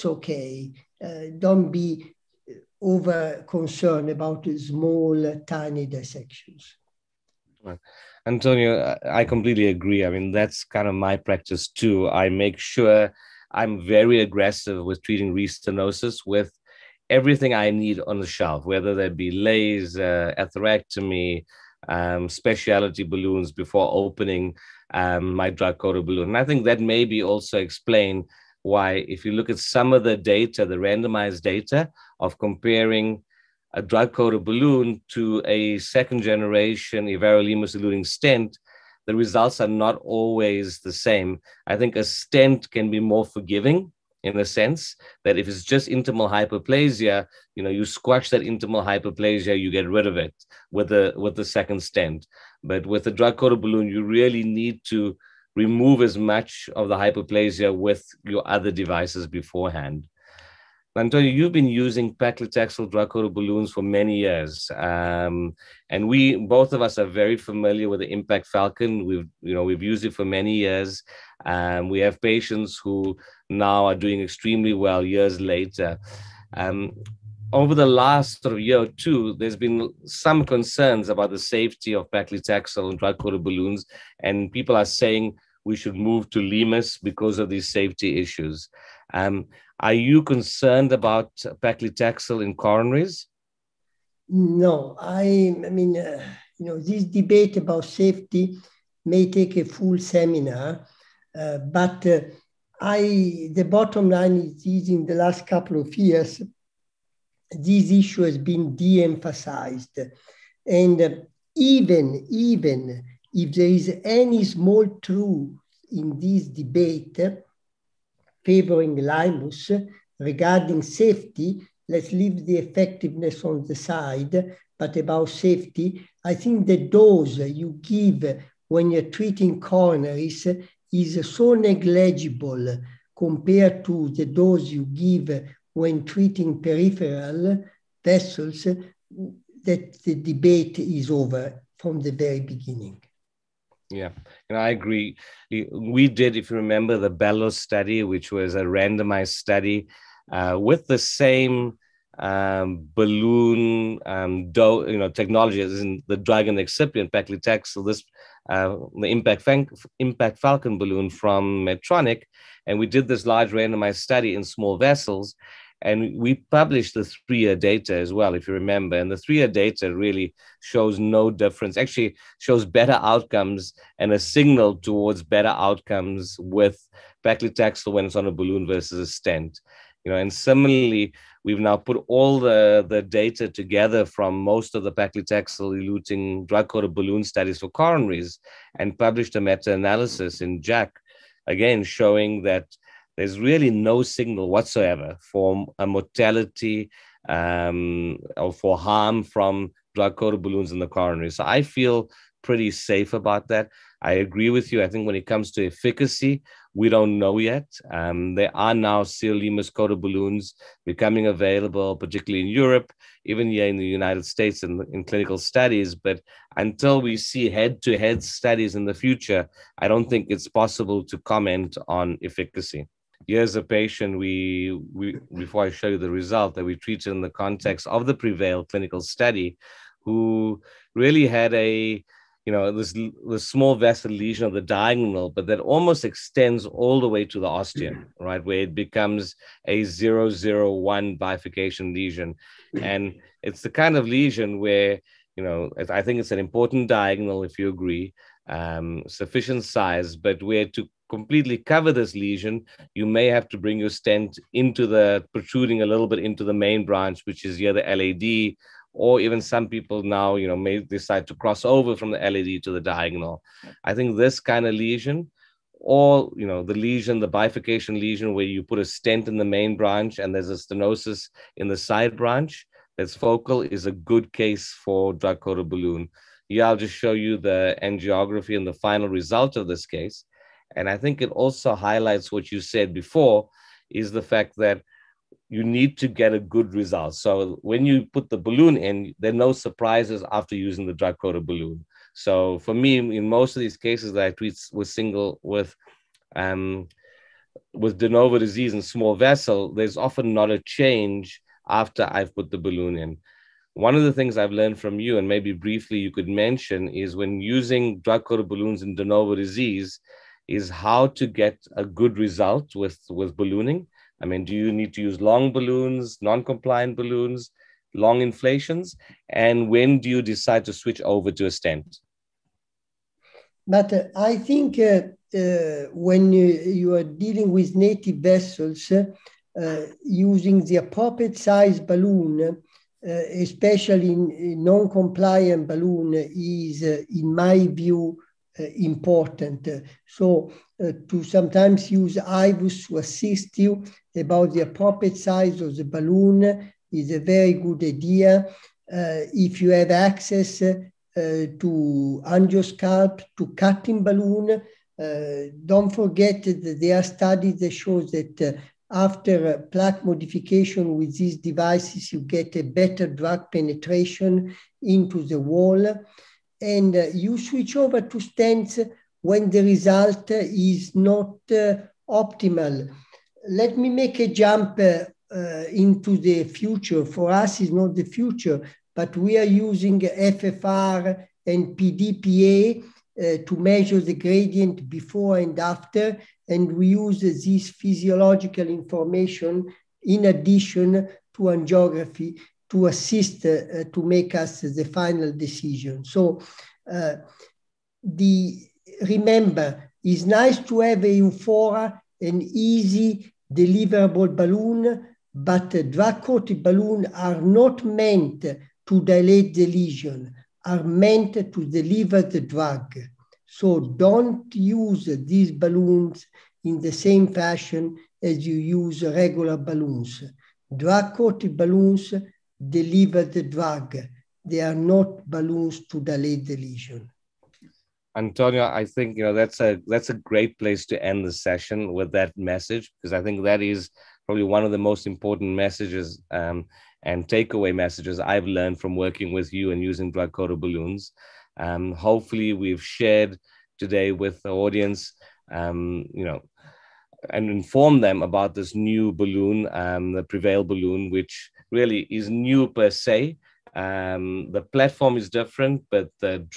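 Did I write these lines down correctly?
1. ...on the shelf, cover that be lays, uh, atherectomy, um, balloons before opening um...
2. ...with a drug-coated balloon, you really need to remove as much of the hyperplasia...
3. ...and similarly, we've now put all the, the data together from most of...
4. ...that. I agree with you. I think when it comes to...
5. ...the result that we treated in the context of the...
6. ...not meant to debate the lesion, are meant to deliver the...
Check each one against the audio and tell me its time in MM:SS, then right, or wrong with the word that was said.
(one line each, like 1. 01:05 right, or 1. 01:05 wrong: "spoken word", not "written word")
1. 00:18 wrong: "whether", not "cover"
2. 00:52 right
3. 03:00 right
4. 03:23 right
5. 03:45 right
6. 06:47 wrong: "dilate", not "debate".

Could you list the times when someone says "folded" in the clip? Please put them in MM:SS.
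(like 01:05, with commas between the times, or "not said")
not said.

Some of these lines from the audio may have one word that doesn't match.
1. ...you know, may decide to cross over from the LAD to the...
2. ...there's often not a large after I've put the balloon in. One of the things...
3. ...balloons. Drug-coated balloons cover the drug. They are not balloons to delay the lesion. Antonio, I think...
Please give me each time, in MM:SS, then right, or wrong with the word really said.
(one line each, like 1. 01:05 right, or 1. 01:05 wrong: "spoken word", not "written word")
1. 04:20 right
2. 04:59 wrong: "change", not "large"
3. 06:59 wrong: "deliver", not "cover".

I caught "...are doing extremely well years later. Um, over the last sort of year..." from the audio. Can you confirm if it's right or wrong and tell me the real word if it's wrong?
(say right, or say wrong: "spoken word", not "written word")
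right.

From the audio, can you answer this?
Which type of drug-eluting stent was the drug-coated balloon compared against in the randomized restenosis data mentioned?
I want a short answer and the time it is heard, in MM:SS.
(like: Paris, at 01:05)
Second-generation everolimus-eluting stent, at 00:35.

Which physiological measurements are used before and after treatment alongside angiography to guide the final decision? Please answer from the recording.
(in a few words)
FFR and Pd/Pa.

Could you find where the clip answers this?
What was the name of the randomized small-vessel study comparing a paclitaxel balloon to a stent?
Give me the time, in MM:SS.
02:27.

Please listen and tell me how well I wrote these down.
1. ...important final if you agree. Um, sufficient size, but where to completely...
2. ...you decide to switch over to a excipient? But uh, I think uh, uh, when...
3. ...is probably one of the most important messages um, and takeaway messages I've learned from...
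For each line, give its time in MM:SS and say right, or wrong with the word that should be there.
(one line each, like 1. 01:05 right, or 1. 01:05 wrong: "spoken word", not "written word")
1. 04:06 wrong: "diagonal", not "final"
2. 05:20 wrong: "stent", not "excipient"
3. 07:13 right.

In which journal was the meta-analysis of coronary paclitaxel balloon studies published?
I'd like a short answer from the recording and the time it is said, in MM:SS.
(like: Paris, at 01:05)
JACC, at 03:10.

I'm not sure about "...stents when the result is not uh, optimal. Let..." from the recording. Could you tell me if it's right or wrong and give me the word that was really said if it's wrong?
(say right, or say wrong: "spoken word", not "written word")
right.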